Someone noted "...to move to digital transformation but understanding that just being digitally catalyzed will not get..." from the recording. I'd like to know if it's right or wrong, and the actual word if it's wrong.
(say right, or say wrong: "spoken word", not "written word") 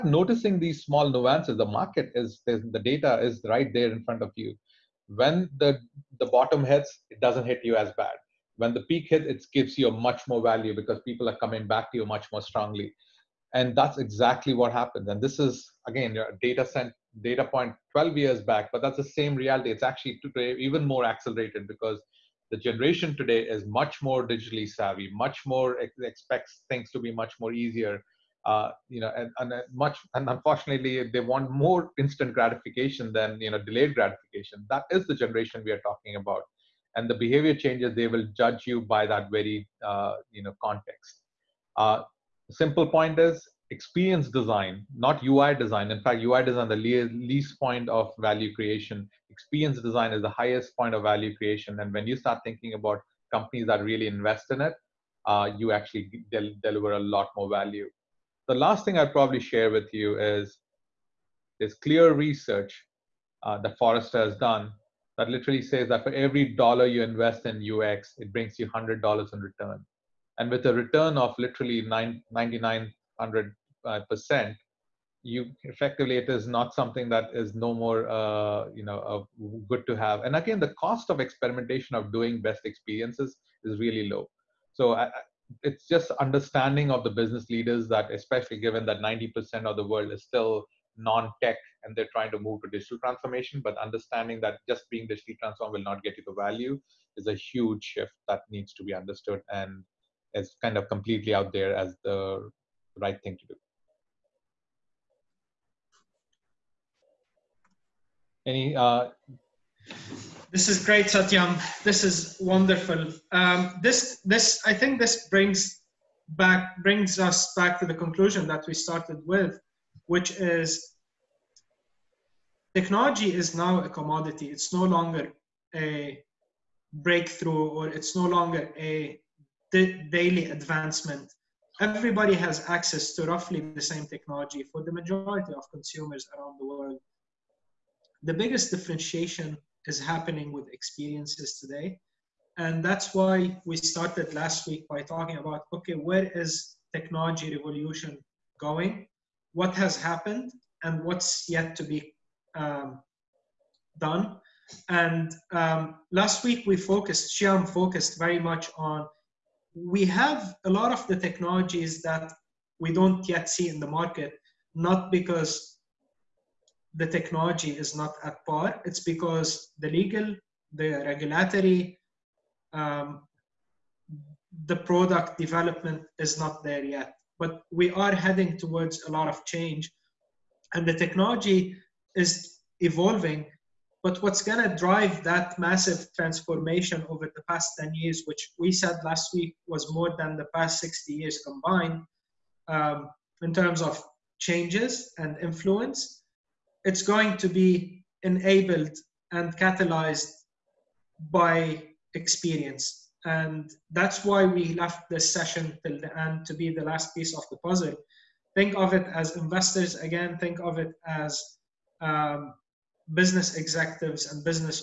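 wrong: "transformed", not "catalyzed".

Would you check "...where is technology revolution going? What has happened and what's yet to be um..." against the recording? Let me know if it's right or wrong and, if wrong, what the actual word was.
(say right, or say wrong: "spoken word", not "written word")
right.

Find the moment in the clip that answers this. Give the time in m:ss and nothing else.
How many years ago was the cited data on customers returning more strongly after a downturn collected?
0:17.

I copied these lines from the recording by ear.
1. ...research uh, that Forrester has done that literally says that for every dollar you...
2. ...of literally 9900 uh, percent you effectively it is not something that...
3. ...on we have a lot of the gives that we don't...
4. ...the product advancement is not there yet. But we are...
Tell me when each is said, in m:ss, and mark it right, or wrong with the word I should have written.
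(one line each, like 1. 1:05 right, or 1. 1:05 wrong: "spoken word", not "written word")
1. 1:02 right
2. 1:11 right
3. 2:38 wrong: "technologies", not "gives"
4. 2:54 wrong: "development", not "advancement".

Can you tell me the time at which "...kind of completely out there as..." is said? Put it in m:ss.
1:40.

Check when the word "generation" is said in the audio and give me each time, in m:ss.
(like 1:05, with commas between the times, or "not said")
0:22, 0:35.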